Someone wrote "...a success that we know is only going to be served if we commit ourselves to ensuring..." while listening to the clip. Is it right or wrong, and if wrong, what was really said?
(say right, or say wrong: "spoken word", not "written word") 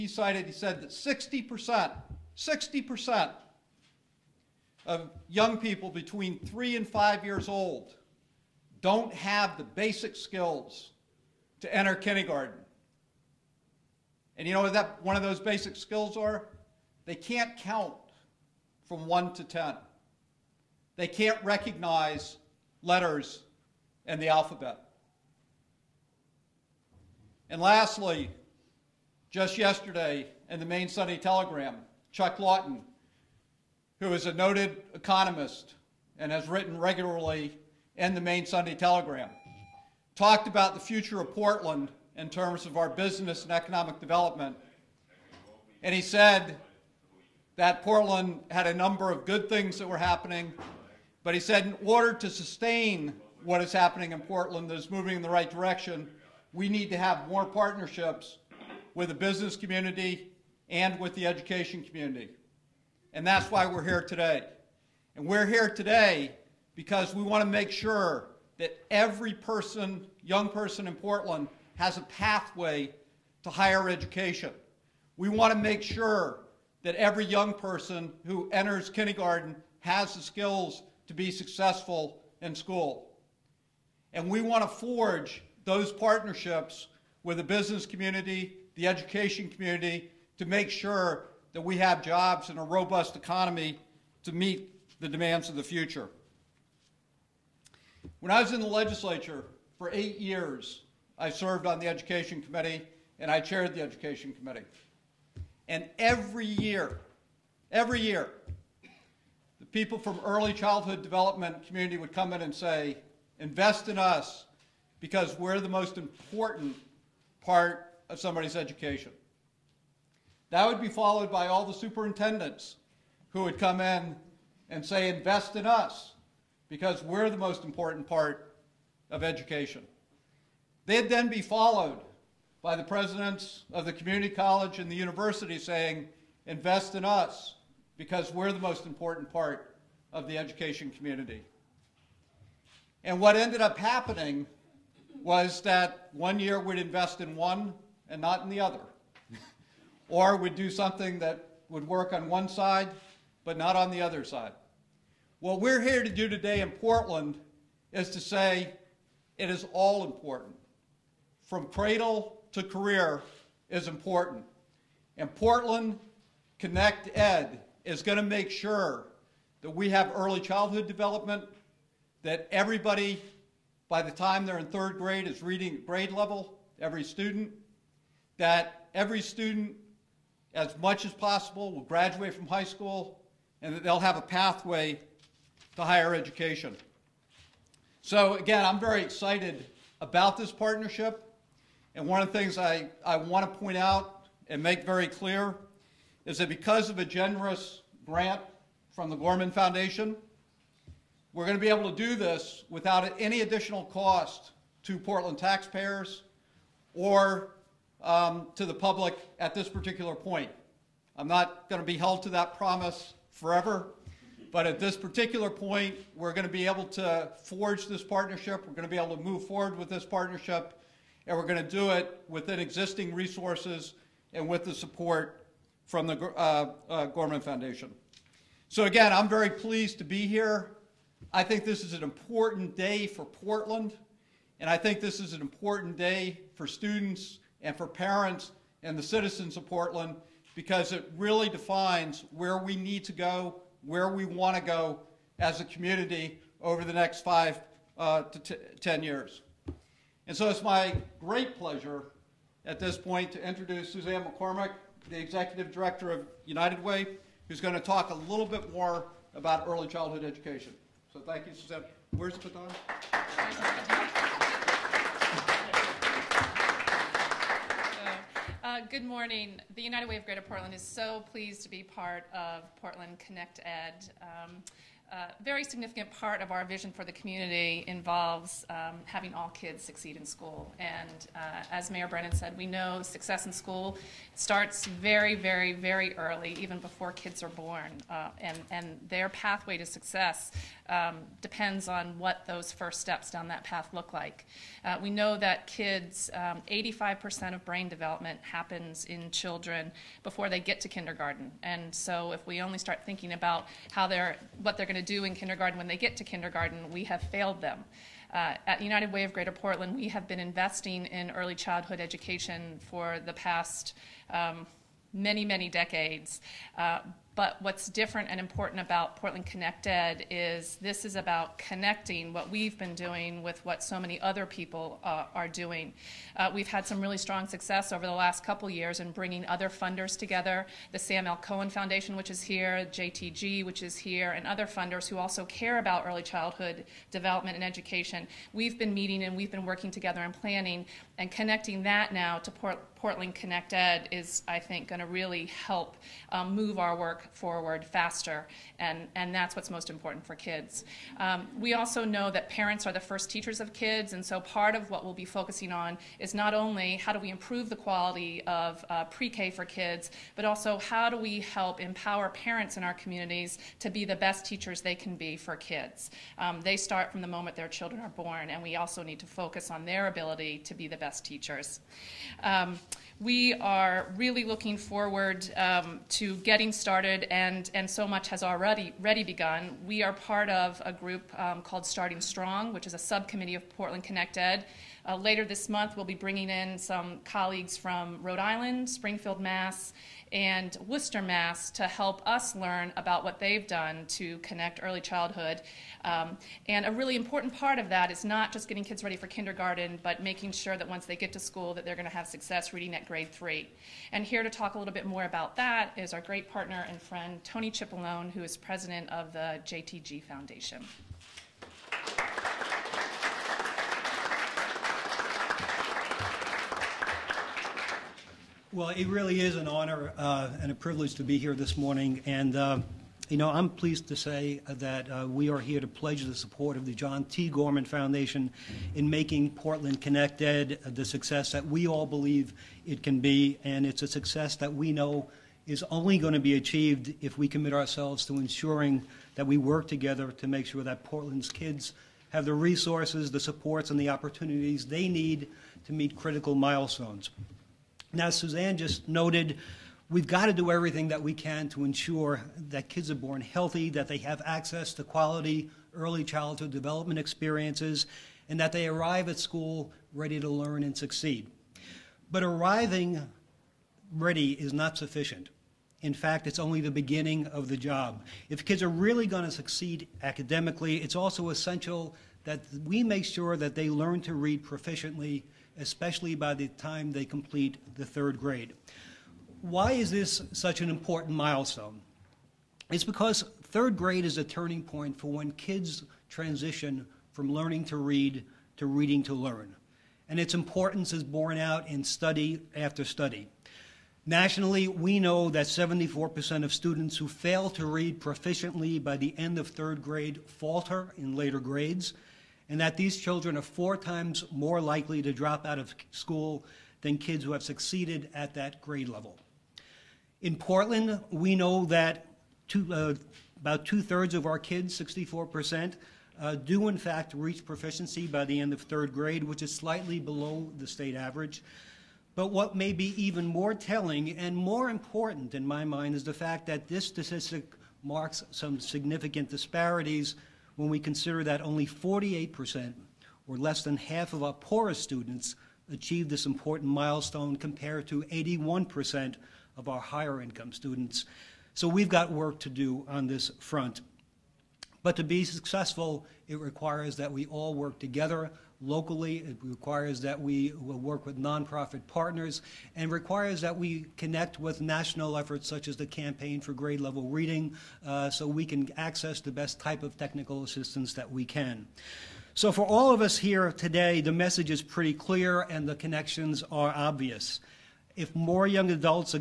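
wrong: "achieved", not "served".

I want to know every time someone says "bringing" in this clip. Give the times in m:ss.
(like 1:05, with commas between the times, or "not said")
5:29, 6:26.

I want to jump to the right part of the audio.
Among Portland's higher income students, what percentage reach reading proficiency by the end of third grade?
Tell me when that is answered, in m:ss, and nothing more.
8:58.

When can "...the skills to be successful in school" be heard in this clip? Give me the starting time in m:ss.
1:20.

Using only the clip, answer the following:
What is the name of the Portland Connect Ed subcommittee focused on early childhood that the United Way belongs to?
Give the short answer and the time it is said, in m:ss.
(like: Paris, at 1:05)
Starting Strong, at 6:21.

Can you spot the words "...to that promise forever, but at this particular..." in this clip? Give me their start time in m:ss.
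3:32.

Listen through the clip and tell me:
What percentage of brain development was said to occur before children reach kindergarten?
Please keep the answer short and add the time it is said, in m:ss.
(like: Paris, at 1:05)
85%, at 4:56.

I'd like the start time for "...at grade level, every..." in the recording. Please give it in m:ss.
2:55.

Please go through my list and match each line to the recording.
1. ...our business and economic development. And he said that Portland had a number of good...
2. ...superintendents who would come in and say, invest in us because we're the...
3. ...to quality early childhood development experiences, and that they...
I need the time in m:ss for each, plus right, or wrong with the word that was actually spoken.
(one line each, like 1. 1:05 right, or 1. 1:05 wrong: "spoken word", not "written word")
1. 0:42 right
2. 2:01 right
3. 7:34 right.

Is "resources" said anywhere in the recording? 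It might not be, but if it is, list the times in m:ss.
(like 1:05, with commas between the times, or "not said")
3:43, 7:22.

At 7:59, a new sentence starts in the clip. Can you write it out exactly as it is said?
Why is this such an important milestone?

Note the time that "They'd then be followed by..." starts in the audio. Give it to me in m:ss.
2:10.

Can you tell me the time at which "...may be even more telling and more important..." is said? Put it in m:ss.
8:42.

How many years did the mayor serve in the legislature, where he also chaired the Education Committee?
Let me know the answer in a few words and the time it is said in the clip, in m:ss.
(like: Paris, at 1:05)
8, at 1:39.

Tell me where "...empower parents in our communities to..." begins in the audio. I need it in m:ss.
6:01.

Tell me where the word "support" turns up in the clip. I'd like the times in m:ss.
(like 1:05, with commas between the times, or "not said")
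3:44, 7:06, 7:23.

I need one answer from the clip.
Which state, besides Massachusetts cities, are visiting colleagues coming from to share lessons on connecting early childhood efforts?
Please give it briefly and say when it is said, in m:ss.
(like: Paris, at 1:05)
Rhode Island, at 6:28.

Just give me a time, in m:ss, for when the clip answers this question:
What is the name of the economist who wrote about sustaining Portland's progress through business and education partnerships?
0:32.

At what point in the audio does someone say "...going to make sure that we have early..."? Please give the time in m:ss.
2:48.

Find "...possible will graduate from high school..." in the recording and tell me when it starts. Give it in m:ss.
3:01.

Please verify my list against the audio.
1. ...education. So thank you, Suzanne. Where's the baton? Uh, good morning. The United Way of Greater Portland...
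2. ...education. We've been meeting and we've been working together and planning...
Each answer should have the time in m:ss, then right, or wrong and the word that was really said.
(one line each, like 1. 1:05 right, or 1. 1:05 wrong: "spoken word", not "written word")
1. 4:20 right
2. 5:37 right.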